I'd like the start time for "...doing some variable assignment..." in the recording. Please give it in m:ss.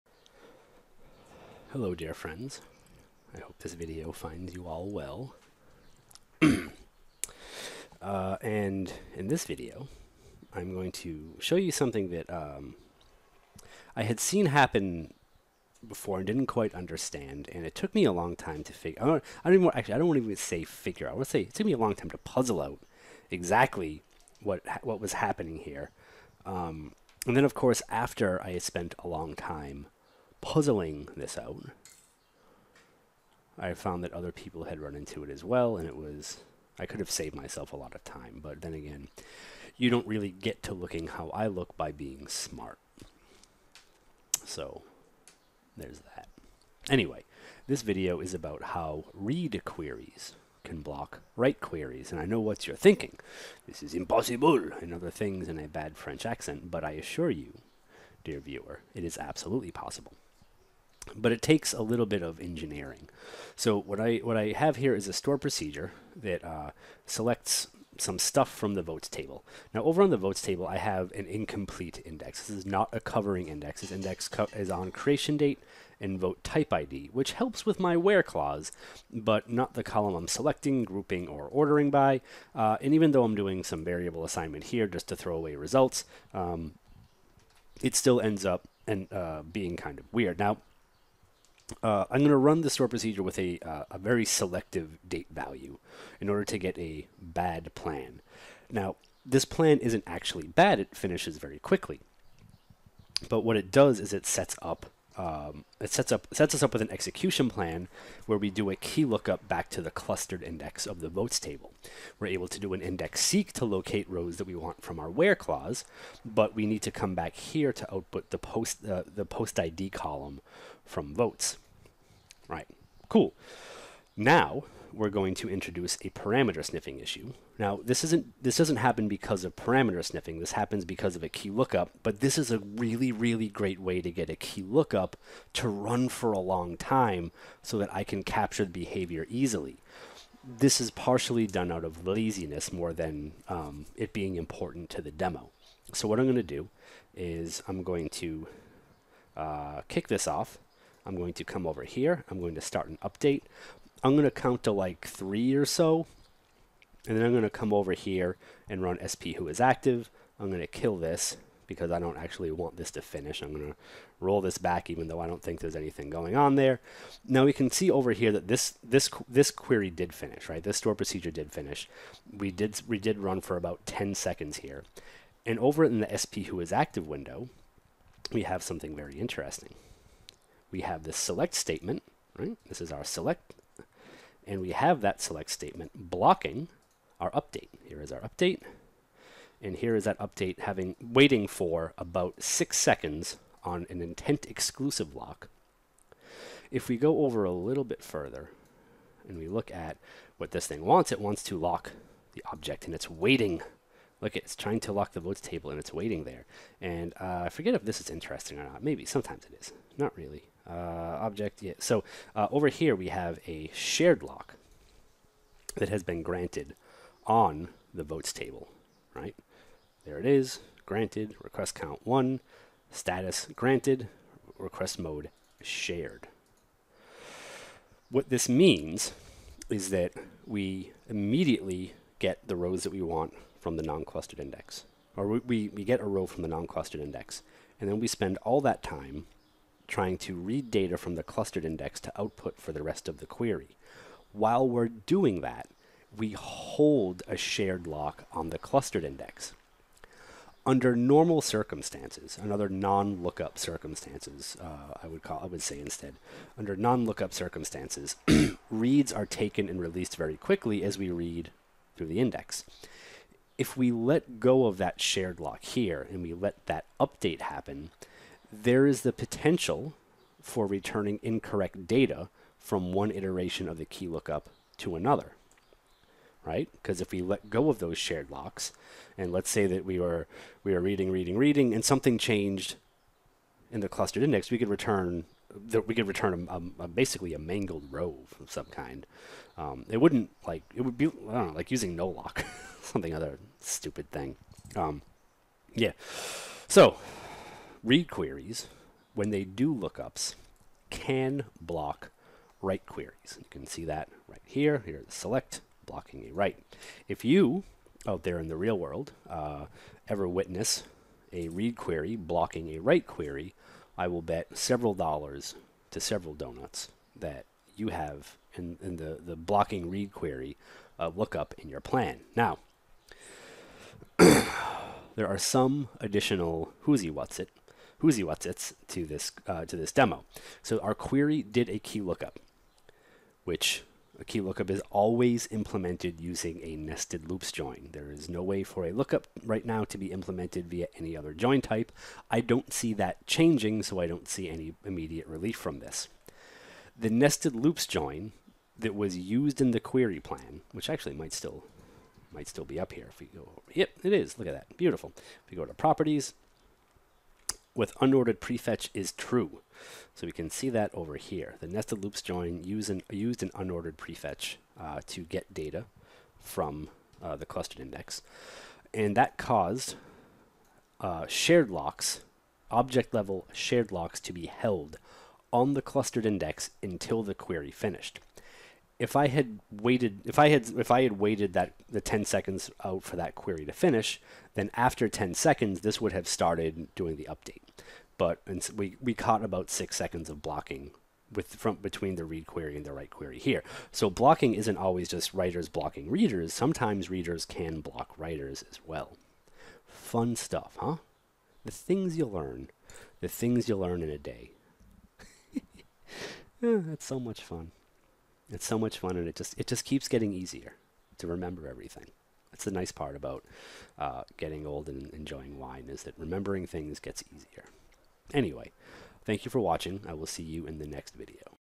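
1:23.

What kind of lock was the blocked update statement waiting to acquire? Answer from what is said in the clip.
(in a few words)
intent exclusive.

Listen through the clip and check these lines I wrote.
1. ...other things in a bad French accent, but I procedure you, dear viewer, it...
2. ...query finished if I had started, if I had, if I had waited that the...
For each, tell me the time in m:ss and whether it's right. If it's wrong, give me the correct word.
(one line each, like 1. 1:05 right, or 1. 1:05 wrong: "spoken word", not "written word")
1. 0:54 wrong: "assure", not "procedure"
2. 6:17 wrong: "waited", not "started".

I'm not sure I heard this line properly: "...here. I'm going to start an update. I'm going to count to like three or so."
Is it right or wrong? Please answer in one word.
right.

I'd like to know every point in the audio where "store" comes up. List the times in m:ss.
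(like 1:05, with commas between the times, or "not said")
1:05, 1:32, 2:50.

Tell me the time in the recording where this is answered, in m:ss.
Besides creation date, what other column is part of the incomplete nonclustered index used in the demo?
1:16.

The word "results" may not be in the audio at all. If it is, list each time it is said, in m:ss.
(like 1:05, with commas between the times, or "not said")
1:25.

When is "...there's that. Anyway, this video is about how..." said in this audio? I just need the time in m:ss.
0:45.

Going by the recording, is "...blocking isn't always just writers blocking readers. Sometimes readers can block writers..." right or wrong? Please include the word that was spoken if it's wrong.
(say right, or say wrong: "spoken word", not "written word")
right.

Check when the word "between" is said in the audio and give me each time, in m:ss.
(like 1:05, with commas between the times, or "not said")
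6:31.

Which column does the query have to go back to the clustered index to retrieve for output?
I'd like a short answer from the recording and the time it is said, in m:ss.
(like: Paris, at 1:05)
post ID, at 1:59.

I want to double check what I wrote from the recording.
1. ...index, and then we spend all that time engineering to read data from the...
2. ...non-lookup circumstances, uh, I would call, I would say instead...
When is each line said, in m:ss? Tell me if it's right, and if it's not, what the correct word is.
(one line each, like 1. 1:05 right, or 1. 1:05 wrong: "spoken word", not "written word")
1. 3:56 wrong: "trying", not "engineering"
2. 4:12 right.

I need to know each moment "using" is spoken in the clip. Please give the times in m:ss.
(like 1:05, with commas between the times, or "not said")
4:51, 5:36.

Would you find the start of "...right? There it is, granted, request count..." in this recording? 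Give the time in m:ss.
3:39.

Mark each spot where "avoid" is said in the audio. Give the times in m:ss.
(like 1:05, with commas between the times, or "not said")
not said.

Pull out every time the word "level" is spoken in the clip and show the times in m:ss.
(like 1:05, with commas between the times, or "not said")
6:13.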